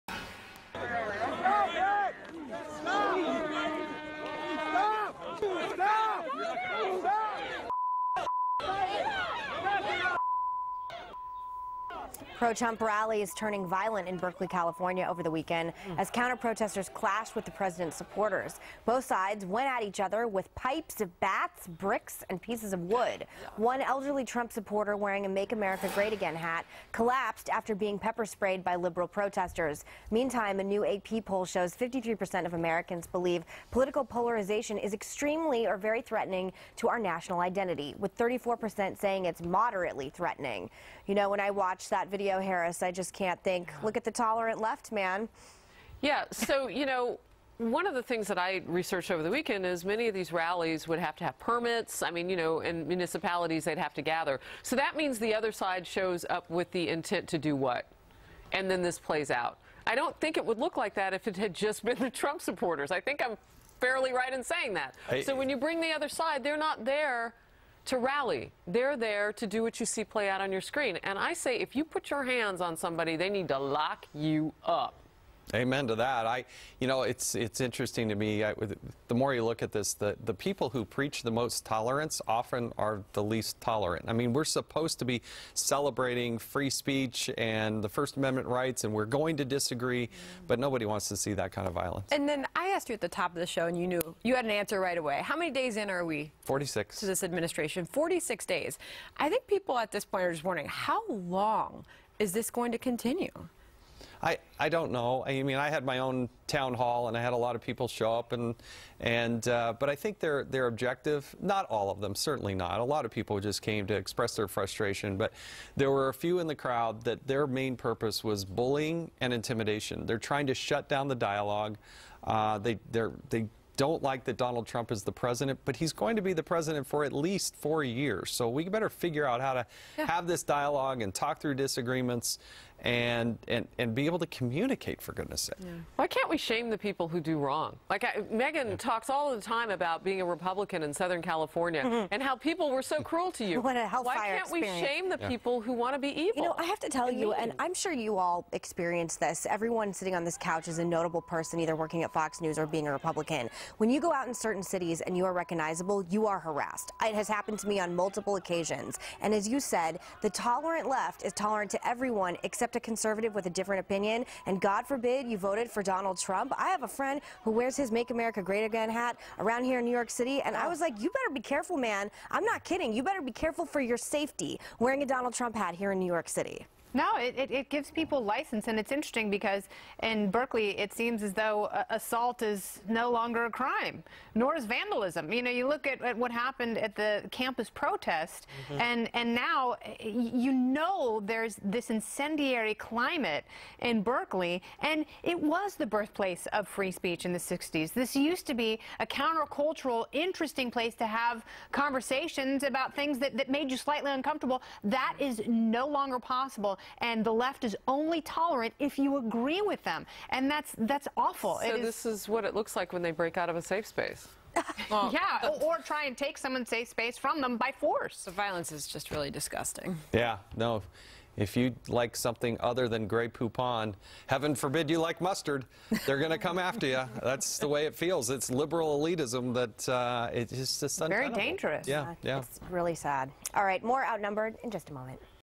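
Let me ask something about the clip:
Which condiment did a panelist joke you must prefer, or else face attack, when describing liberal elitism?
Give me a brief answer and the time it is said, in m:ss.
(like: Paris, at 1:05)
Grey Poupon, at 3:43.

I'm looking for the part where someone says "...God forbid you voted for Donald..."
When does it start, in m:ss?
2:44.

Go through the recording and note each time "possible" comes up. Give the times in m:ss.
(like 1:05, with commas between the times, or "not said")
3:26.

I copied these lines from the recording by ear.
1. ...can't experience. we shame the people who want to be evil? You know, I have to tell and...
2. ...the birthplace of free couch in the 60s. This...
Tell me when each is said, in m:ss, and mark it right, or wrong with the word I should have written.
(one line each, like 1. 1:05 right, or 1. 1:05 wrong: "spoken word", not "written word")
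1. 2:24 right
2. 3:15 wrong: "speech", not "couch".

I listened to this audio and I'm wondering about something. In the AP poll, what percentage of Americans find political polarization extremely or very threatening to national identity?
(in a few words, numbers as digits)
53%.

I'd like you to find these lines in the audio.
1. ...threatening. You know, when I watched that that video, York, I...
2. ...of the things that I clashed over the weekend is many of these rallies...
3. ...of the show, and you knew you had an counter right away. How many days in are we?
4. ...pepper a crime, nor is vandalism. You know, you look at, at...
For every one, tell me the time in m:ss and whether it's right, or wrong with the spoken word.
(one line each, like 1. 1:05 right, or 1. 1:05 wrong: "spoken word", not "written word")
1. 0:40 wrong: "Harris", not "York"
2. 0:47 wrong: "researched", not "clashed"
3. 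1:33 wrong: "answer", not "counter"
4. 3:03 wrong: "longer", not "pepper".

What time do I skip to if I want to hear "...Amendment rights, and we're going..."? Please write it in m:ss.
1:28.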